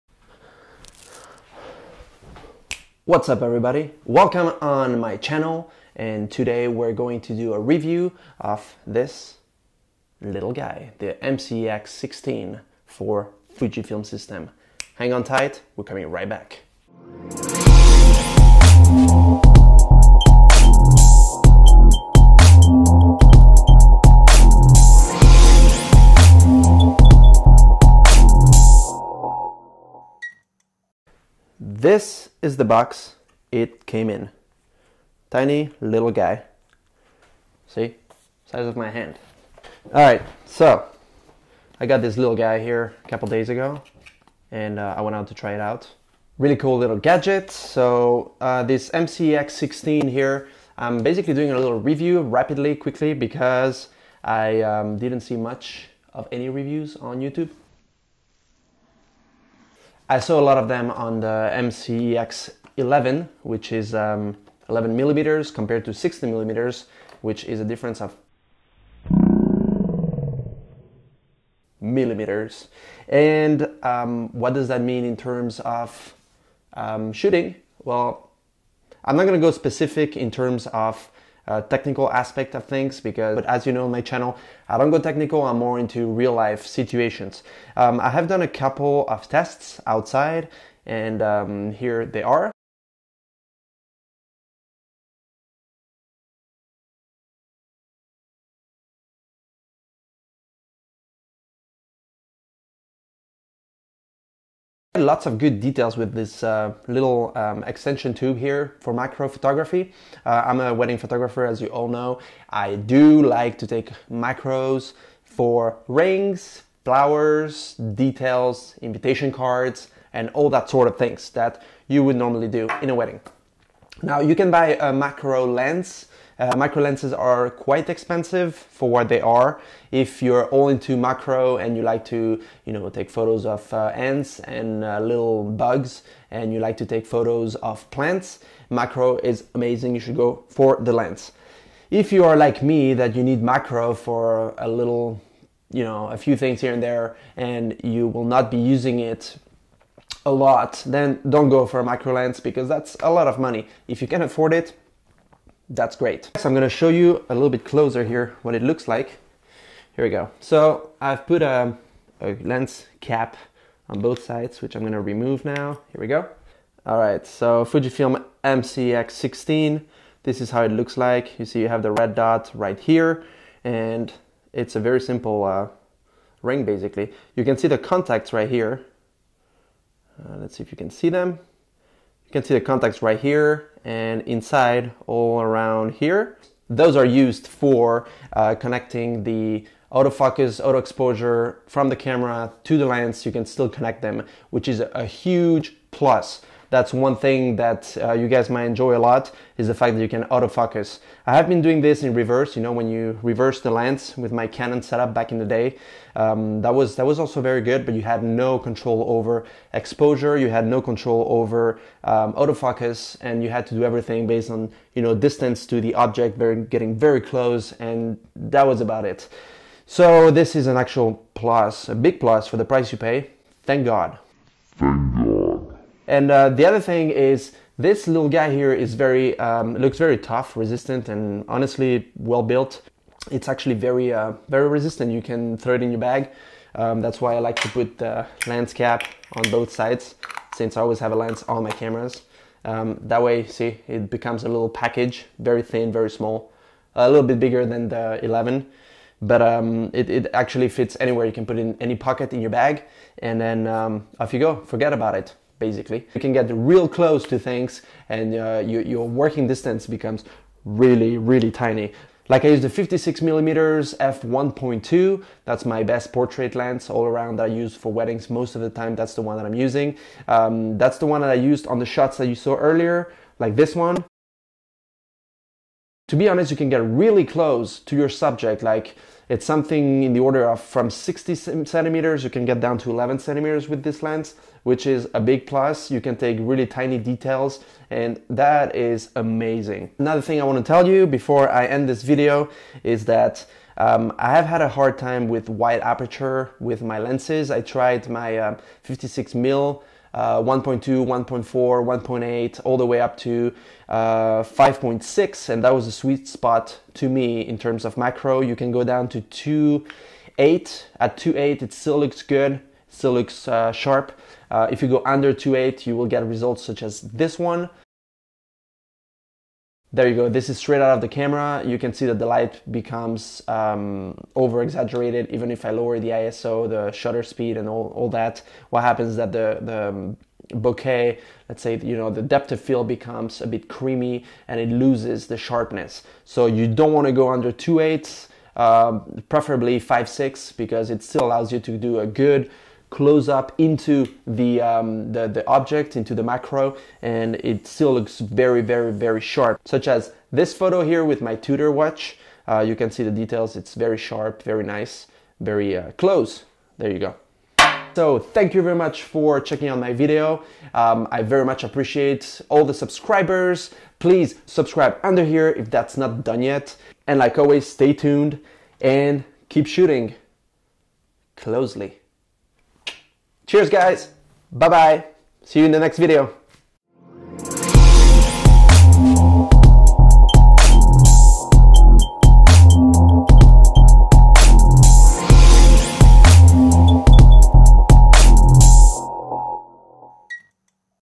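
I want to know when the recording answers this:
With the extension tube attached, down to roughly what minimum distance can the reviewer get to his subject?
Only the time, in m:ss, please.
4:42.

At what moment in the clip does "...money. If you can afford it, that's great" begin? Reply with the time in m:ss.
2:33.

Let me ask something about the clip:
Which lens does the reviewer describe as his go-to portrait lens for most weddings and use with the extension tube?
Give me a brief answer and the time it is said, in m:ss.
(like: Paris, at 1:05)
56mm f1.2, at 4:22.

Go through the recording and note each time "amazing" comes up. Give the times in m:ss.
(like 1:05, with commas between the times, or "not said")
2:19, 4:49.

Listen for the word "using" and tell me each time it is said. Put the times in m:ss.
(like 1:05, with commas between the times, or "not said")
2:28, 4:29.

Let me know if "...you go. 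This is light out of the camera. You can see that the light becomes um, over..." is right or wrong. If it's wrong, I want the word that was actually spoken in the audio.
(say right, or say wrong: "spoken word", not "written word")
wrong: "straight", not "light".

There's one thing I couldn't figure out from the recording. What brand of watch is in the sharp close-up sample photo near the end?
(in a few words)
Tudor.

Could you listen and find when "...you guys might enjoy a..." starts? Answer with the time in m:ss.
3:18.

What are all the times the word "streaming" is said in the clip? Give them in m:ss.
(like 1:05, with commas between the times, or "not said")
not said.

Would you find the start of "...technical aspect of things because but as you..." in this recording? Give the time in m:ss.
1:21.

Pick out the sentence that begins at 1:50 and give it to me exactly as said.
Uh, I'm a wedding photographer, as you all know.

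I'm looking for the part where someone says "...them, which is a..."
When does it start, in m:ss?
3:14.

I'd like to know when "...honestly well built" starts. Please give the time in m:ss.
3:51.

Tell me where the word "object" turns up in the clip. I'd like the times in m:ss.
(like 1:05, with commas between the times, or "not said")
3:35, 5:45.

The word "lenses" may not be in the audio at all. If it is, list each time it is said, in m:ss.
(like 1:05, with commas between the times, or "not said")
2:06, 4:56.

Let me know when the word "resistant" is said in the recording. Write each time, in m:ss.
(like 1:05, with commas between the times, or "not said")
3:50, 3:54.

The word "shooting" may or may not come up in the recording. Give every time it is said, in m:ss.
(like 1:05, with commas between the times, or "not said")
1:17, 6:09.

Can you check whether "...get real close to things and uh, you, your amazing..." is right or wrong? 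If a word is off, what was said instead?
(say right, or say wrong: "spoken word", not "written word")
wrong: "working", not "amazing".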